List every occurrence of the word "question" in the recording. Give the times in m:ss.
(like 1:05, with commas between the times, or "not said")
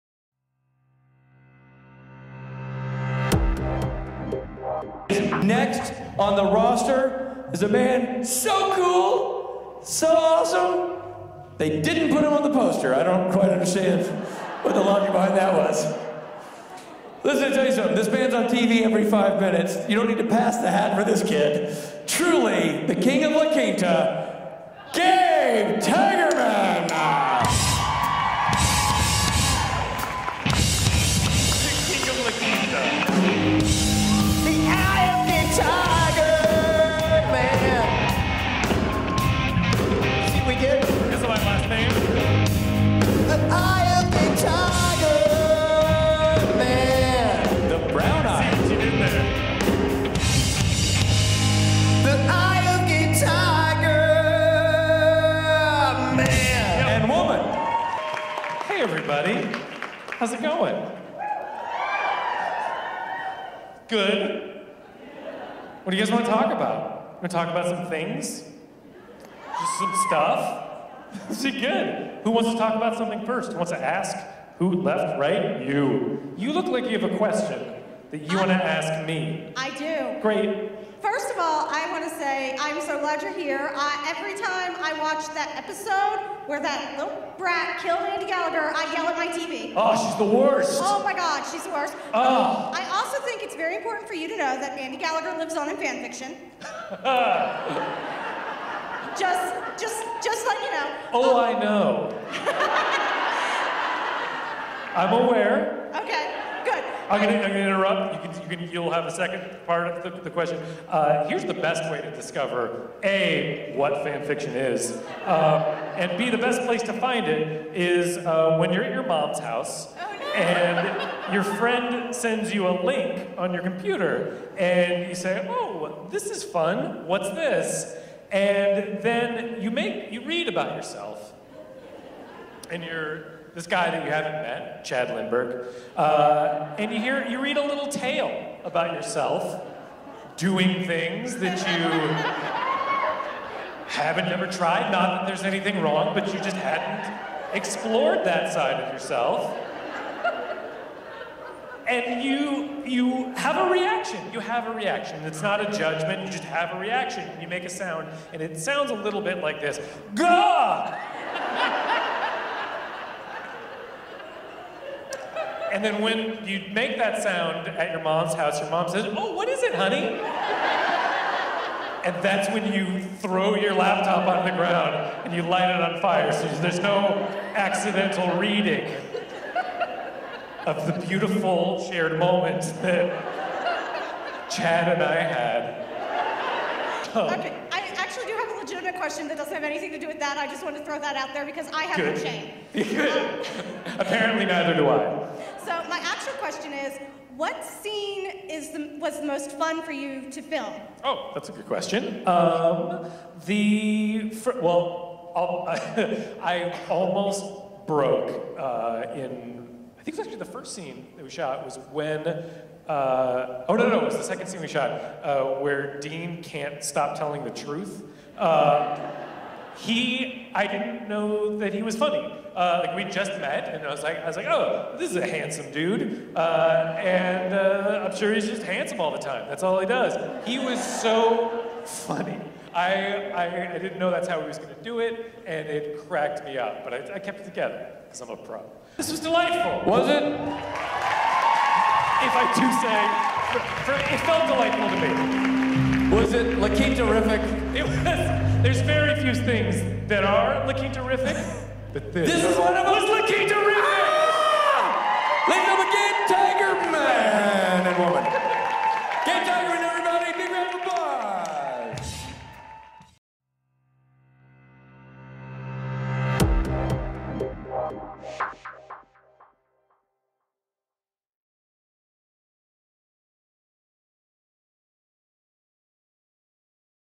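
1:17, 1:50, 3:08, 3:16, 3:21.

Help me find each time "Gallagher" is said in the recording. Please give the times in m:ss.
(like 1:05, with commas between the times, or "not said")
1:28, 1:34.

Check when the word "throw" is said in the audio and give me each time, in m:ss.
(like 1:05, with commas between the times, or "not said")
2:53, 3:10.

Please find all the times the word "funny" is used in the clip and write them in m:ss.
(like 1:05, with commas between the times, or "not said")
3:41, 3:51.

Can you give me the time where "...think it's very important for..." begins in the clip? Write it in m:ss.
1:33.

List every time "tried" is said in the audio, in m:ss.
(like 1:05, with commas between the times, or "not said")
2:24.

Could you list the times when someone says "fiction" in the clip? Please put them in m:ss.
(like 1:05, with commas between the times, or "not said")
1:36, 1:54.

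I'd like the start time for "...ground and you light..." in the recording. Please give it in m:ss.
2:54.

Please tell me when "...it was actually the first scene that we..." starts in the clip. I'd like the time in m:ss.
3:30.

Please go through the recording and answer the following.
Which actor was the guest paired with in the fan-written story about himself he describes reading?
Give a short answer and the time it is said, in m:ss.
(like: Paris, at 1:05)
Chad Lindberg, at 2:14.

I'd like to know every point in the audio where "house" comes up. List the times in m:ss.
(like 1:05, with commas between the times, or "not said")
1:59, 2:48.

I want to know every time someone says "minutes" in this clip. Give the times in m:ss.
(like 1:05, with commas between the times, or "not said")
0:19.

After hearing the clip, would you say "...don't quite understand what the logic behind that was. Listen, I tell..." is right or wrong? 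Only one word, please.
right.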